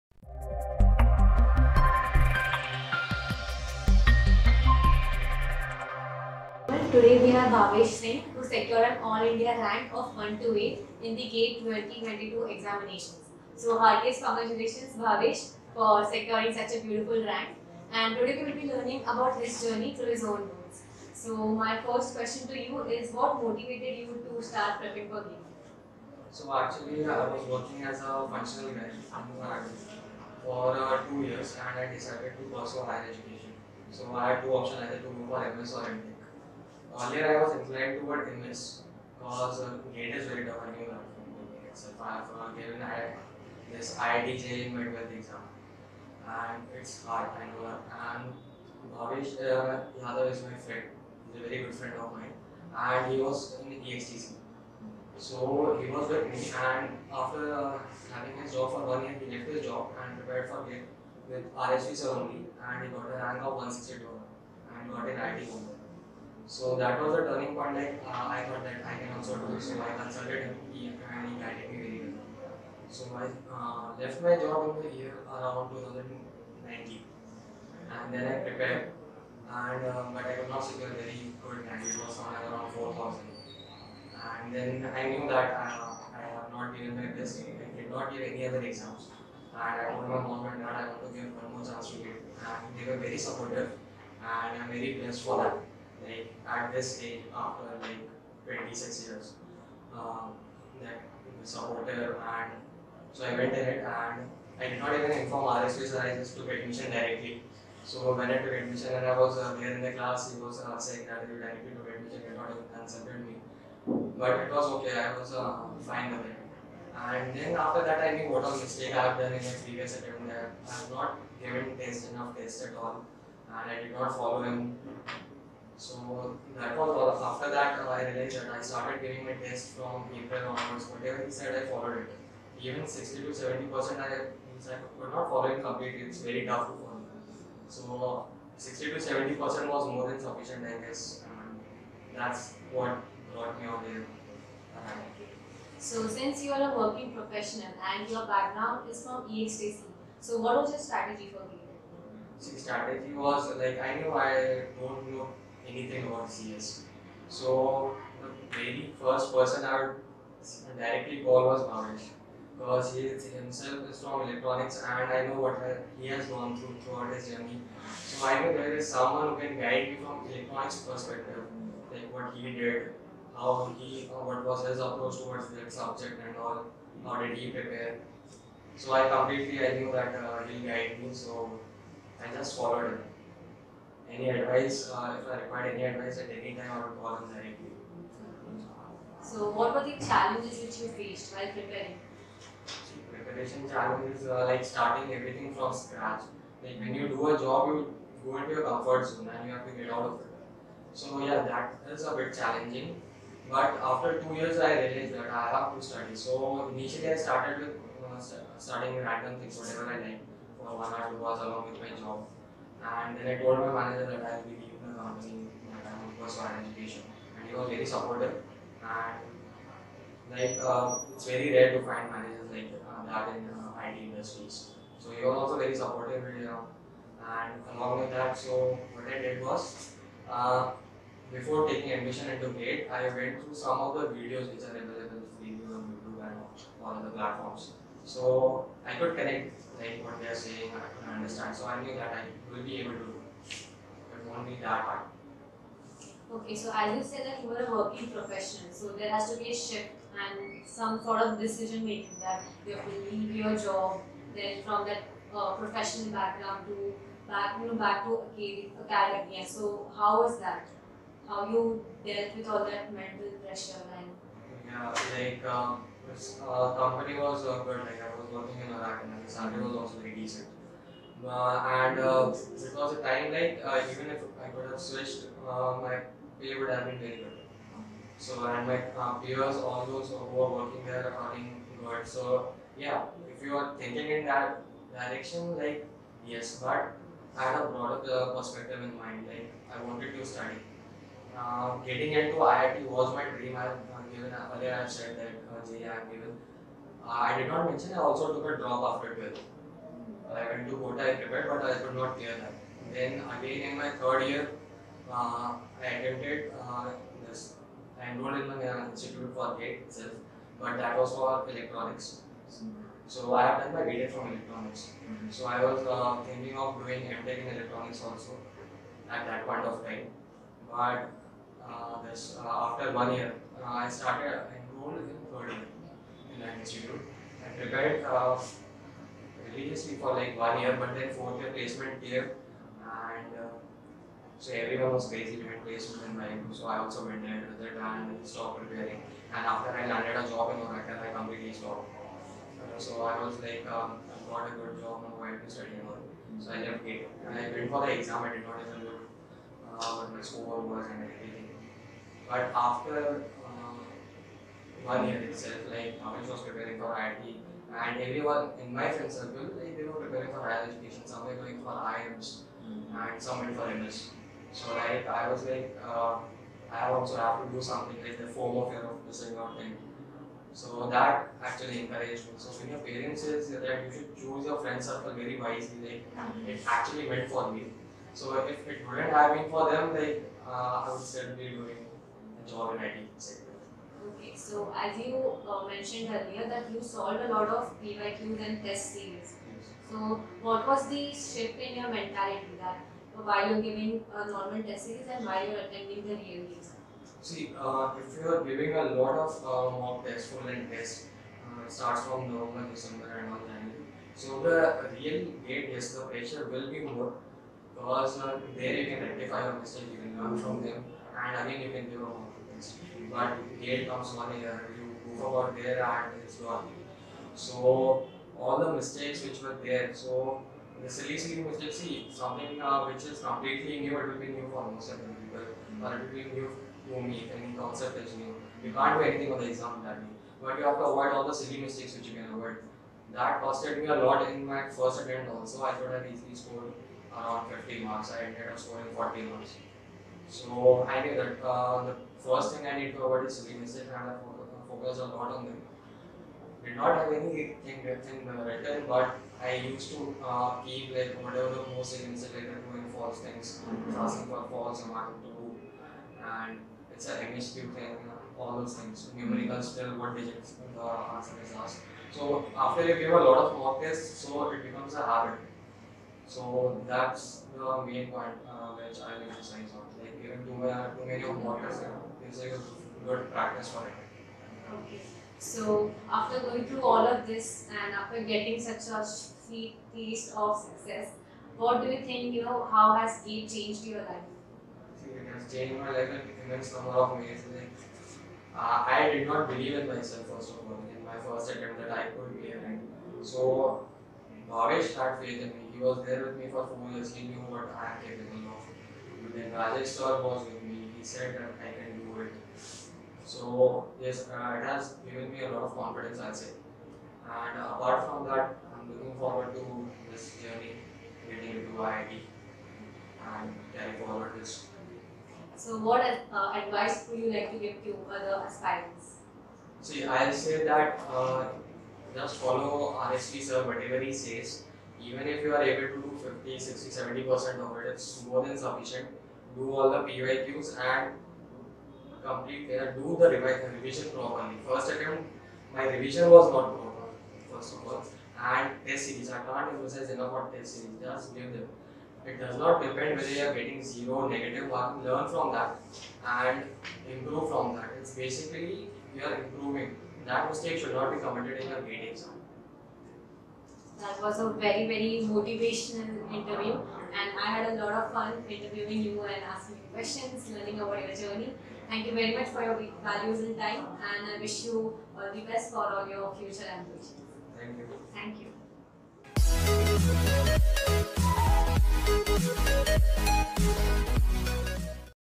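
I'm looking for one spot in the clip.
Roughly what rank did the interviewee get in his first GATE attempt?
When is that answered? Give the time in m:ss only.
1:22.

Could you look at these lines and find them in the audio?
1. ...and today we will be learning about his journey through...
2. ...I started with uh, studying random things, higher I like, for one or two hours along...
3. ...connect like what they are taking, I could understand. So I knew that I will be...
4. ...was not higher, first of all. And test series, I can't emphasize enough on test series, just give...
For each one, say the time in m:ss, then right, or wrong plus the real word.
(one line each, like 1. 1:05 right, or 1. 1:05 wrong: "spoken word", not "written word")
1. 0:17 right
2. 3:27 wrong: "whatever", not "higher"
3. 3:59 wrong: "saying", not "taking"
4. 8:56 wrong: "proper", not "higher".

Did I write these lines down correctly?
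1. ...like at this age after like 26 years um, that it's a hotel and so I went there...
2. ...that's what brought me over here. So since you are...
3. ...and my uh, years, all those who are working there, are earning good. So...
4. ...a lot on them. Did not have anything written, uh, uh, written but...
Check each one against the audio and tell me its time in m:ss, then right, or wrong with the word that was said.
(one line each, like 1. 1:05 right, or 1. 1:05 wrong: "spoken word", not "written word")
1. 1:36 right
2. 2:22 right
3. 4:38 wrong: "peers", not "years"
4. 7:24 right.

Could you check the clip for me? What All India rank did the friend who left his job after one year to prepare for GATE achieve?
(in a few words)
162.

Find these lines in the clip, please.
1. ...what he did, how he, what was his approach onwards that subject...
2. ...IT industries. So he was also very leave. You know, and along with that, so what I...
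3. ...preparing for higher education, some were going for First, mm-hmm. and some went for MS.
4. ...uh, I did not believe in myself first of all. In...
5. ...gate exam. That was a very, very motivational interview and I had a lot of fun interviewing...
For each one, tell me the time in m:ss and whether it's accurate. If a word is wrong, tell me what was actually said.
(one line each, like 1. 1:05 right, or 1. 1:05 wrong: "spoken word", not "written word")
1. 2:52 wrong: "towards", not "onwards"
2. 3:43 wrong: "supportive", not "leave"
3. 6:00 wrong: "IIMs", not "First"
4. 8:08 right
5. 9:11 right.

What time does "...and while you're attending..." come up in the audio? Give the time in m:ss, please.
6:35.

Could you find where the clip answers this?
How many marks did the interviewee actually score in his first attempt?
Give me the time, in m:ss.
7:18.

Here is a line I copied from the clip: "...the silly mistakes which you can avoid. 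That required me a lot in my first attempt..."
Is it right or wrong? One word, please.
wrong.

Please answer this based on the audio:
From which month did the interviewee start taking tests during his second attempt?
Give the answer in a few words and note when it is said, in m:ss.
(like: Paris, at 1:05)
April, at 2:10.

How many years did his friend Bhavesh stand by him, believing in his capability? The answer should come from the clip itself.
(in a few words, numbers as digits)
4.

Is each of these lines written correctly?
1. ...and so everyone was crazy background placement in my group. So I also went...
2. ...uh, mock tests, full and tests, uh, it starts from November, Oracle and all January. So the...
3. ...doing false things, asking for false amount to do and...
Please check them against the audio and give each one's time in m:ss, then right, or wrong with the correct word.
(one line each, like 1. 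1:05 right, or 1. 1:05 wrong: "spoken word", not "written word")
1. 5:32 wrong: "behind", not "background"
2. 6:39 wrong: "December", not "Oracle"
3. 7:32 right.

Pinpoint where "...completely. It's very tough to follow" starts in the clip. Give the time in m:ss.
2:15.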